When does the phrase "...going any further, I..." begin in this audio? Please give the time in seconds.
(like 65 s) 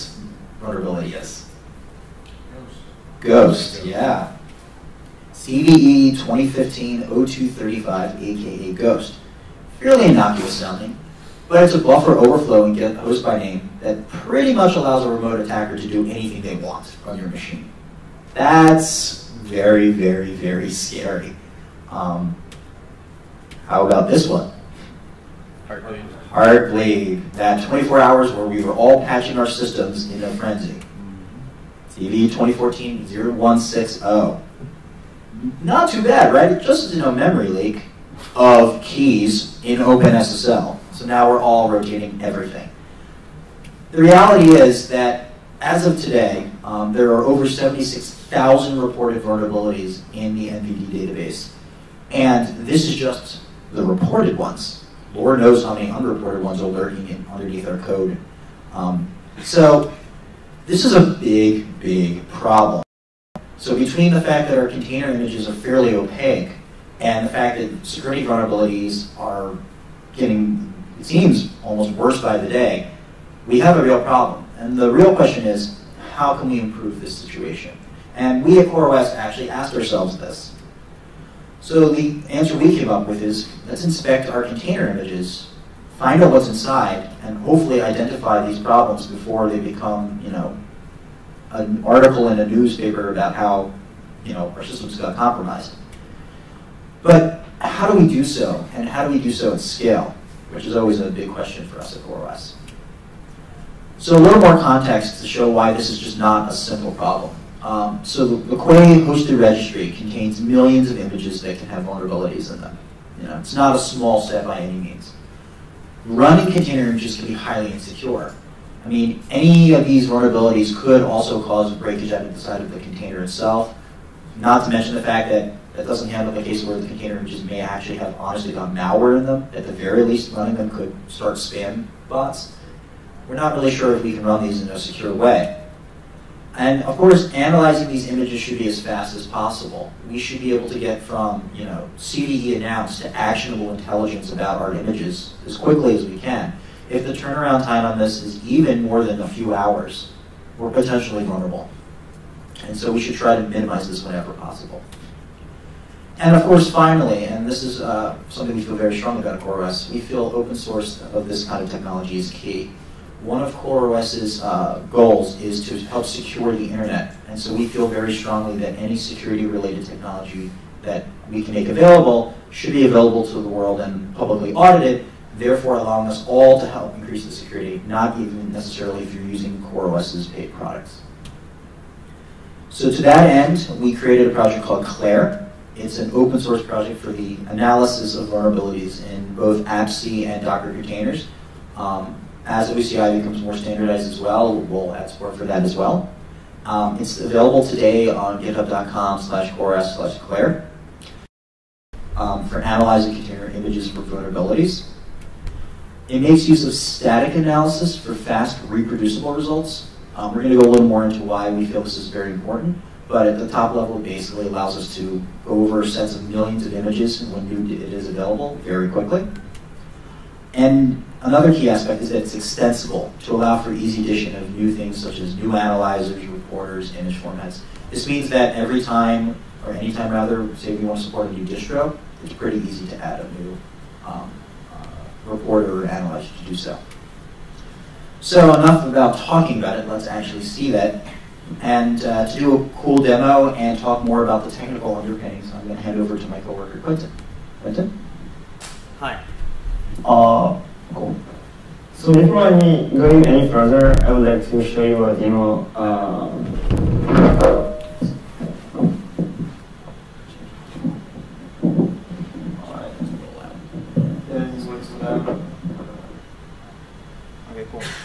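252 s.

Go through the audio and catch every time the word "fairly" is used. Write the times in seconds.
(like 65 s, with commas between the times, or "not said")
9 s, 65 s.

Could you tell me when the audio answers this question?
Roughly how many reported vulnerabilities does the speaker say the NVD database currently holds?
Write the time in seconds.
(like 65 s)
47 s.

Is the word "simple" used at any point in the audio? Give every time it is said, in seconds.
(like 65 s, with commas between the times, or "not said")
106 s.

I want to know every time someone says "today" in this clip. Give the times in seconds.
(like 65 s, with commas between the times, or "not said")
46 s, 197 s.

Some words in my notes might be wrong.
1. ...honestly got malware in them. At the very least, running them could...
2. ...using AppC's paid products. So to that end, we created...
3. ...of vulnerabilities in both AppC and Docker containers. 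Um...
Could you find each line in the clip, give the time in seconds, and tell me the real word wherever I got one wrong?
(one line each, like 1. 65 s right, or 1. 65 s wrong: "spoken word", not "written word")
1. 128 s right
2. 179 s wrong: "CoreOS", not "AppC"
3. 188 s right.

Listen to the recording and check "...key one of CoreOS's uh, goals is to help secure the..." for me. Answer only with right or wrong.
right.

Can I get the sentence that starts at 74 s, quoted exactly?
And the real question is, how can we improve this situation?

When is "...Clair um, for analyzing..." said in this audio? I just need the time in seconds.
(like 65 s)
200 s.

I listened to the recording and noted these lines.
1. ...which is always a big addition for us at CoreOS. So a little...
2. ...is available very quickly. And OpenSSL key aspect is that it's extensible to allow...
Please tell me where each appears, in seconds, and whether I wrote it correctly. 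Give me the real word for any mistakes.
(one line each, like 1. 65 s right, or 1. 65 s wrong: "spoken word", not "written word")
1. 100 s wrong: "question", not "addition"
2. 217 s wrong: "Another", not "OpenSSL".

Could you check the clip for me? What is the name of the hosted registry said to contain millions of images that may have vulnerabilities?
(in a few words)
Quay.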